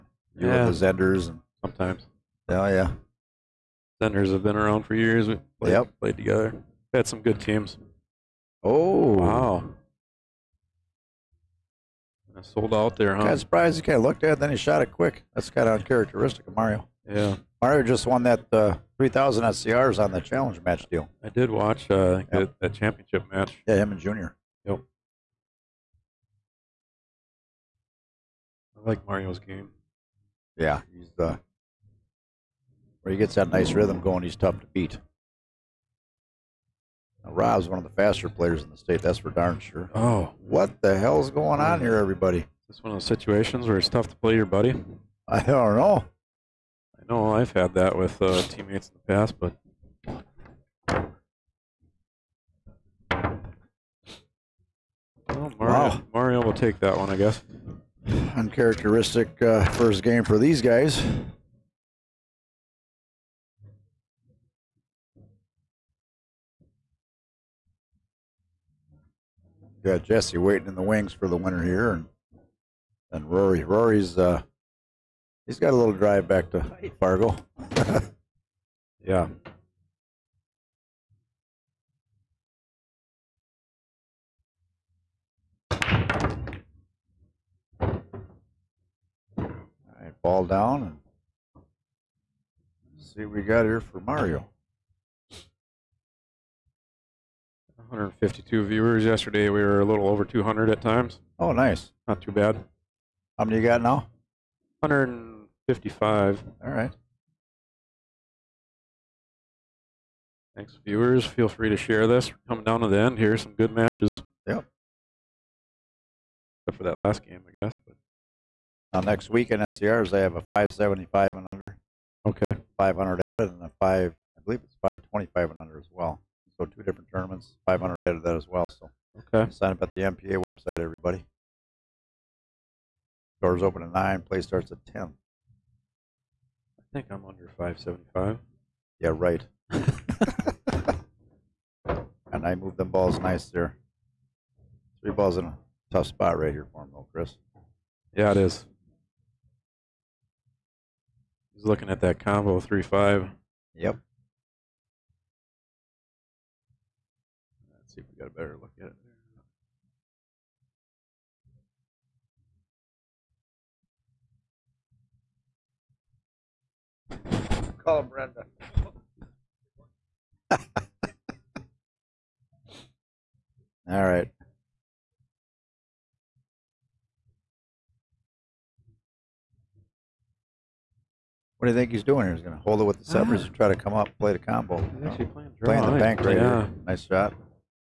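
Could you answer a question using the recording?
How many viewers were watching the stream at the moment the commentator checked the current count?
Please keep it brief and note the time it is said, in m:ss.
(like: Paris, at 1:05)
155, at 1:44.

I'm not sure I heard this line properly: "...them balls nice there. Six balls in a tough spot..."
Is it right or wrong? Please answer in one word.
wrong.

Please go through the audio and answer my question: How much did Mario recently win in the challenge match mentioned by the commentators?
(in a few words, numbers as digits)
3,000.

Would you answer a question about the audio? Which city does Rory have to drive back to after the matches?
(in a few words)
Fargo.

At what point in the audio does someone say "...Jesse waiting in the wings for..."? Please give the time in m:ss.
1:10.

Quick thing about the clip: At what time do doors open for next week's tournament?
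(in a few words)
9.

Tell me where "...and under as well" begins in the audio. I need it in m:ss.
2:05.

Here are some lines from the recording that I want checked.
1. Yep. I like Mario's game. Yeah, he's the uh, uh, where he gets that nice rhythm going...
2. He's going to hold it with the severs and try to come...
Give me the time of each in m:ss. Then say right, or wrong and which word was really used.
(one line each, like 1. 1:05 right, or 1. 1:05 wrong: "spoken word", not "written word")
1. 0:24 right
2. 3:02 right.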